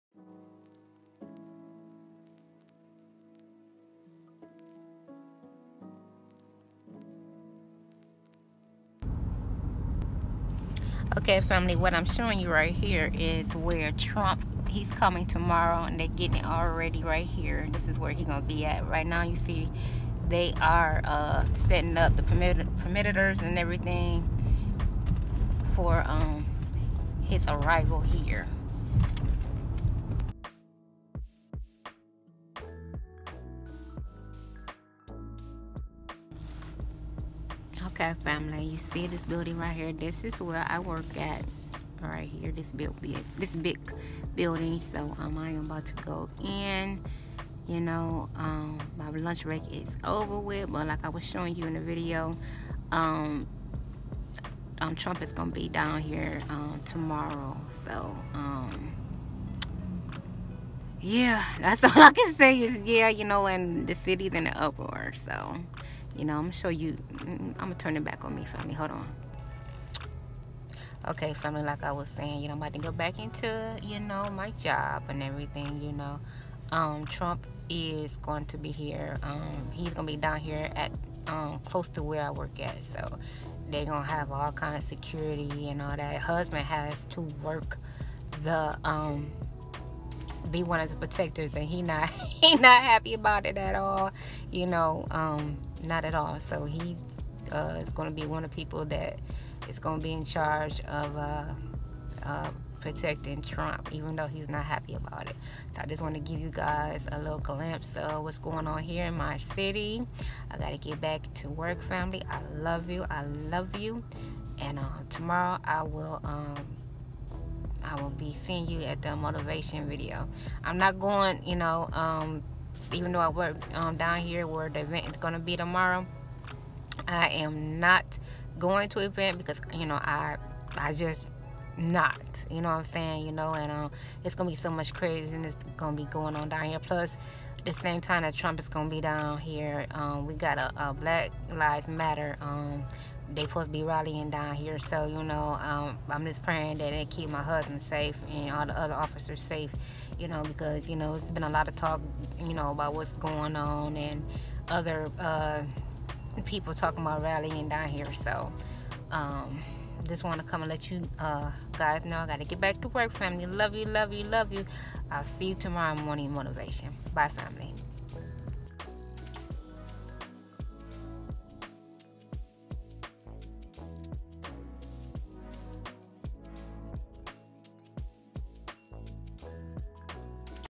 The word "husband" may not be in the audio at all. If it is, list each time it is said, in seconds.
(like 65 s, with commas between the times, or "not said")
86 s, 147 s.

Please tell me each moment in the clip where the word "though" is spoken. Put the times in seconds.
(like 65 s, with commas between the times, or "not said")
104 s, 123 s.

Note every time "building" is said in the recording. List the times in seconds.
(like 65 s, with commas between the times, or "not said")
39 s, 44 s.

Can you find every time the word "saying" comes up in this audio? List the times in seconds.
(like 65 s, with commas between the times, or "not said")
72 s, 132 s.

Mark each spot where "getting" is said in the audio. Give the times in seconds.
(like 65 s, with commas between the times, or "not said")
16 s.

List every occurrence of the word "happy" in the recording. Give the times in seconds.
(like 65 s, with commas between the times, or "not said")
92 s, 104 s.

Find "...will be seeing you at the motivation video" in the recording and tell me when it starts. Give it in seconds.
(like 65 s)
118 s.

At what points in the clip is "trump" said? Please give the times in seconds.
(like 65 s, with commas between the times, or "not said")
13 s, 54 s, 77 s, 103 s, 138 s.